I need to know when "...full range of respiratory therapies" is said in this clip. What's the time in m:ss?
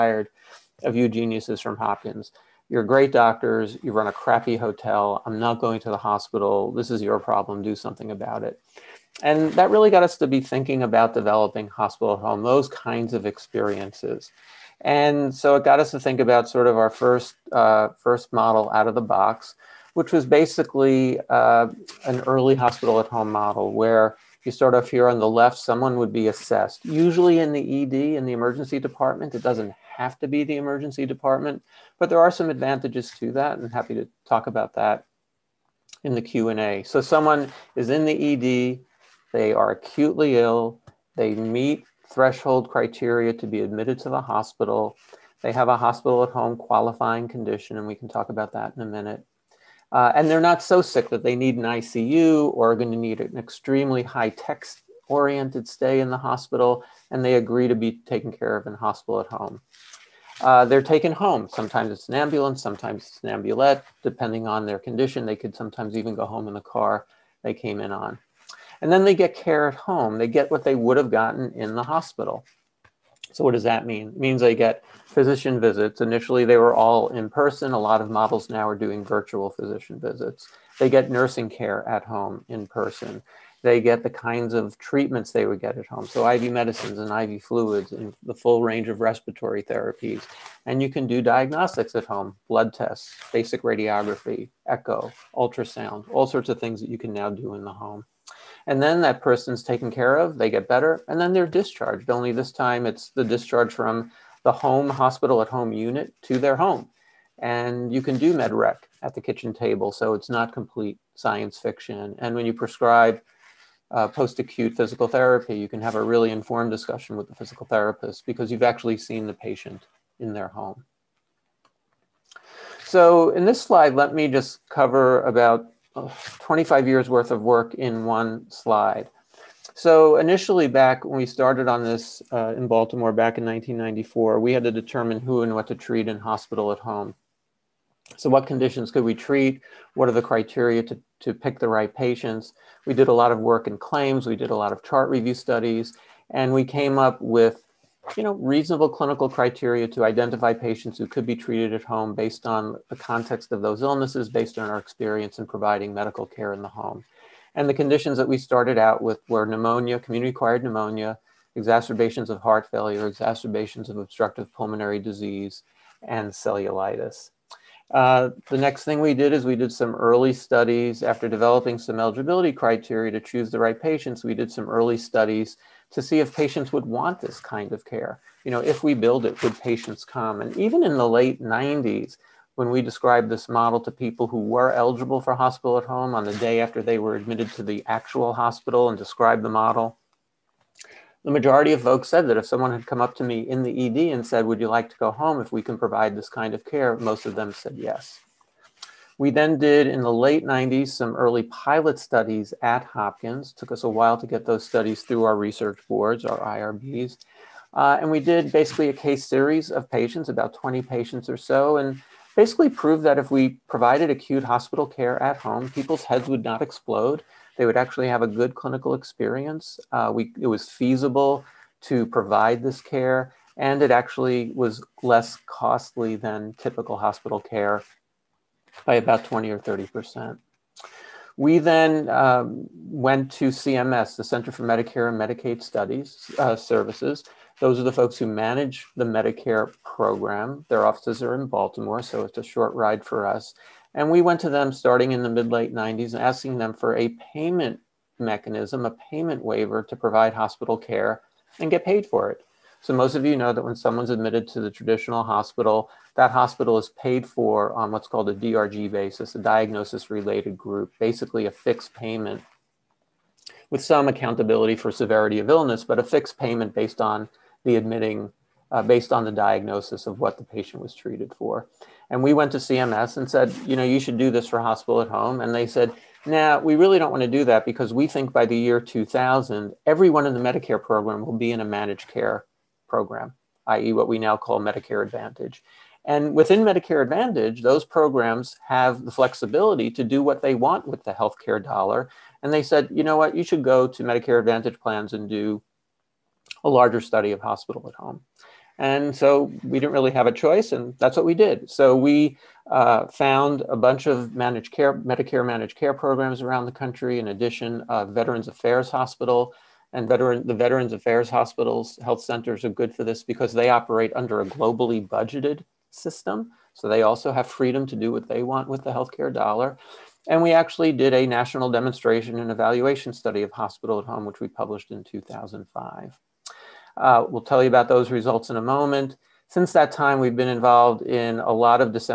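1:28.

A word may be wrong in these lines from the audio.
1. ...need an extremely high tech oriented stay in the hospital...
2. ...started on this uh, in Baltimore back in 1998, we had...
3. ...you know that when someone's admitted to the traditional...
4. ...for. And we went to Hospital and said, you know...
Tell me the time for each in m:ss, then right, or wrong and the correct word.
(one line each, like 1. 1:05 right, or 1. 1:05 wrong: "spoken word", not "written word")
1. 0:52 right
2. 2:11 wrong: "1994", not "1998"
3. 4:13 right
4. 4:31 wrong: "CMS", not "Hospital".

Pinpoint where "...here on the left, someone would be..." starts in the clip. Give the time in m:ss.
0:24.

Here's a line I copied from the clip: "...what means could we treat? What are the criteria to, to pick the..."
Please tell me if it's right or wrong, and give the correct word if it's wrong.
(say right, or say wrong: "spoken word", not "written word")
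wrong: "conditions", not "means".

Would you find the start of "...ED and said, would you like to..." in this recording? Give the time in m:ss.
3:13.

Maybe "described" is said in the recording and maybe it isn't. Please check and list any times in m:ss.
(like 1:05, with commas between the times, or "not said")
3:02, 3:08.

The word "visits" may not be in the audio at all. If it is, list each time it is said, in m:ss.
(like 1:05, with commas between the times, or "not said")
1:15, 1:19.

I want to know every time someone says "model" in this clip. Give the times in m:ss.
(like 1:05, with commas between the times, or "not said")
0:18, 0:23, 1:18, 3:03, 3:09.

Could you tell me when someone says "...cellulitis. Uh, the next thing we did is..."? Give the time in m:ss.
2:46.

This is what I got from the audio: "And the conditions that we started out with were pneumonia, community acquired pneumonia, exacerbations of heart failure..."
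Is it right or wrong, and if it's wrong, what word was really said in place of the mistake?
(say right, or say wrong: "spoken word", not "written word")
right.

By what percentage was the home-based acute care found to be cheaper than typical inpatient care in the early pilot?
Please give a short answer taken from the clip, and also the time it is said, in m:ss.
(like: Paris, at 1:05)
20 or 30%, at 3:49.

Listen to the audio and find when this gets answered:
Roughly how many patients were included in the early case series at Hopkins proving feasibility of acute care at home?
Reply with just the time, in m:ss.
3:30.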